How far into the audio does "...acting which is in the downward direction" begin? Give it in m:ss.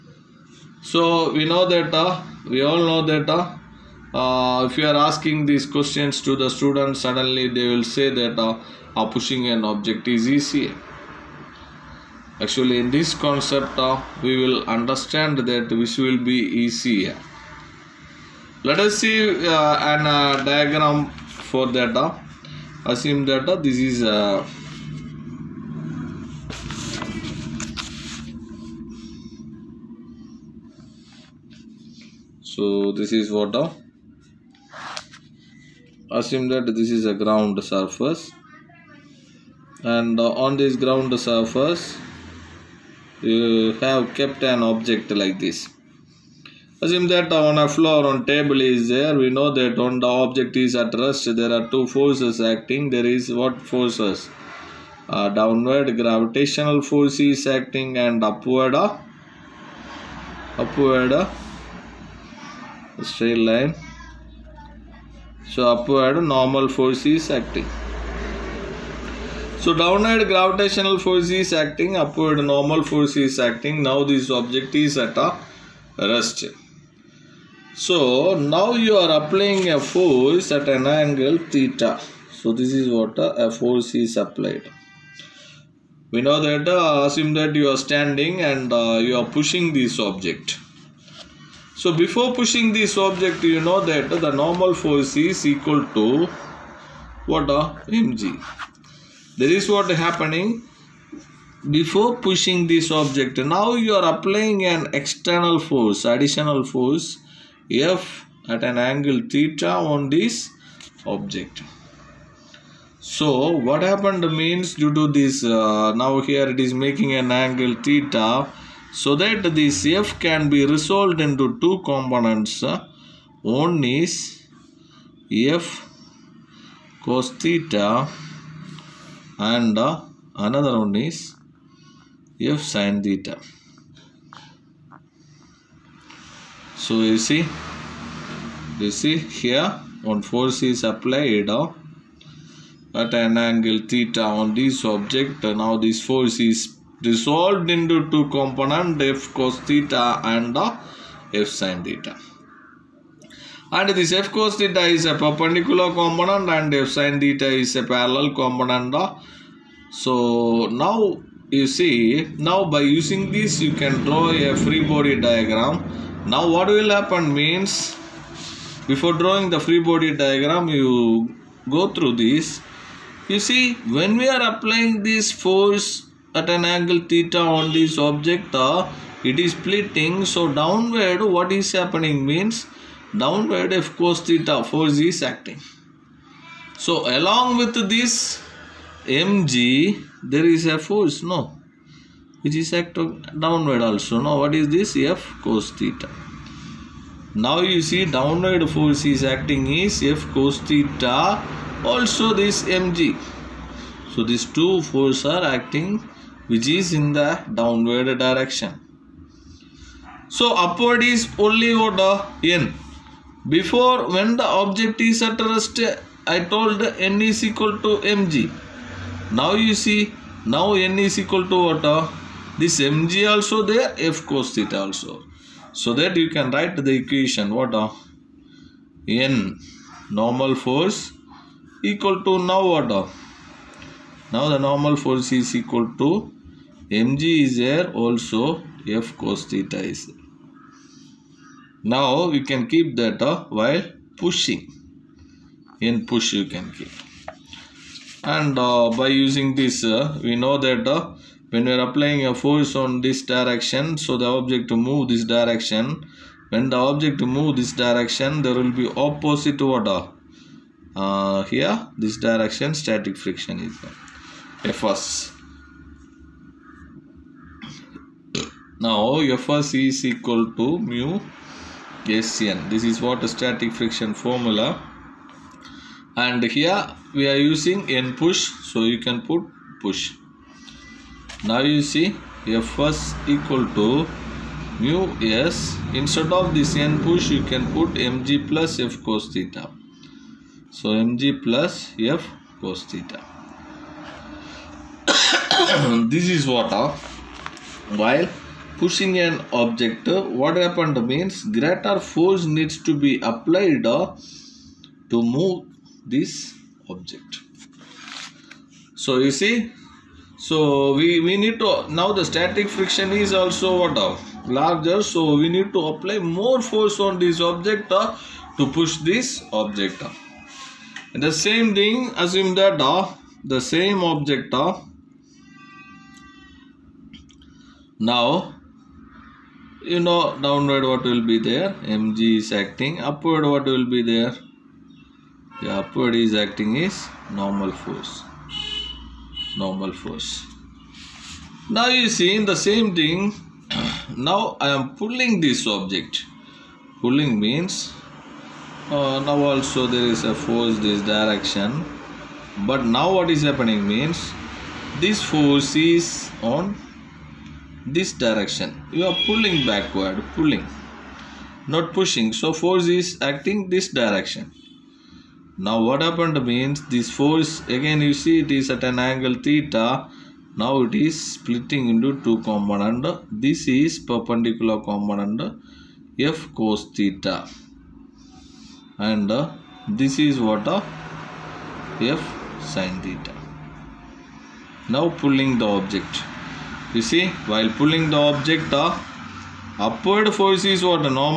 3:25.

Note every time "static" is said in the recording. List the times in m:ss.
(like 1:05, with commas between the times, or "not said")
4:22, 4:33, 5:12.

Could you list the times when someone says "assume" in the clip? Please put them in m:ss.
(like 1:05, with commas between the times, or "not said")
0:22, 0:36, 0:46, 1:27, 5:22.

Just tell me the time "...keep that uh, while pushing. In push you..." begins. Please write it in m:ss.
4:02.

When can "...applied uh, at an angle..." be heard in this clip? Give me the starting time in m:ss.
2:20.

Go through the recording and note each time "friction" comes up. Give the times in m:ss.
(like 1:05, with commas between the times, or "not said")
4:23, 4:33, 5:12.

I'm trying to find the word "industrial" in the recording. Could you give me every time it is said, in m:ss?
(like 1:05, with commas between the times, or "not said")
not said.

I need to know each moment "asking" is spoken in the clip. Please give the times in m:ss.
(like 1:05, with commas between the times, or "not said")
0:04.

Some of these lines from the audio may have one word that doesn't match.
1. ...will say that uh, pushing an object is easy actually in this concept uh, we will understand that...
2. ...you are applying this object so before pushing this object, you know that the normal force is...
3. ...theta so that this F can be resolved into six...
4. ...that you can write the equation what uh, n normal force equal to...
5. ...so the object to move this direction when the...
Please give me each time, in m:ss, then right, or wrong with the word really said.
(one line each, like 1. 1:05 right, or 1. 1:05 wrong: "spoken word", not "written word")
1. 0:07 right
2. 1:29 wrong: "pushing", not "applying"
3. 1:57 wrong: "two", not "six"
4. 3:45 right
5. 4:13 right.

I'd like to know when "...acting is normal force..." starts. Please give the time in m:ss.
5:36.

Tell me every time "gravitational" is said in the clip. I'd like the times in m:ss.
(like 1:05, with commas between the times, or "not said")
0:56, 1:10.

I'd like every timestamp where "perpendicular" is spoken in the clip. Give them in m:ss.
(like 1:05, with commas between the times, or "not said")
2:35, 6:13.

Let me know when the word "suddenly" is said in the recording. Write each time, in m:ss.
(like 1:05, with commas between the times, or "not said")
0:06.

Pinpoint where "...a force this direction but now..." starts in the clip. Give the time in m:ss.
5:50.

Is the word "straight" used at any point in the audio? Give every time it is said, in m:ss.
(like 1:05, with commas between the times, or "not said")
1:03.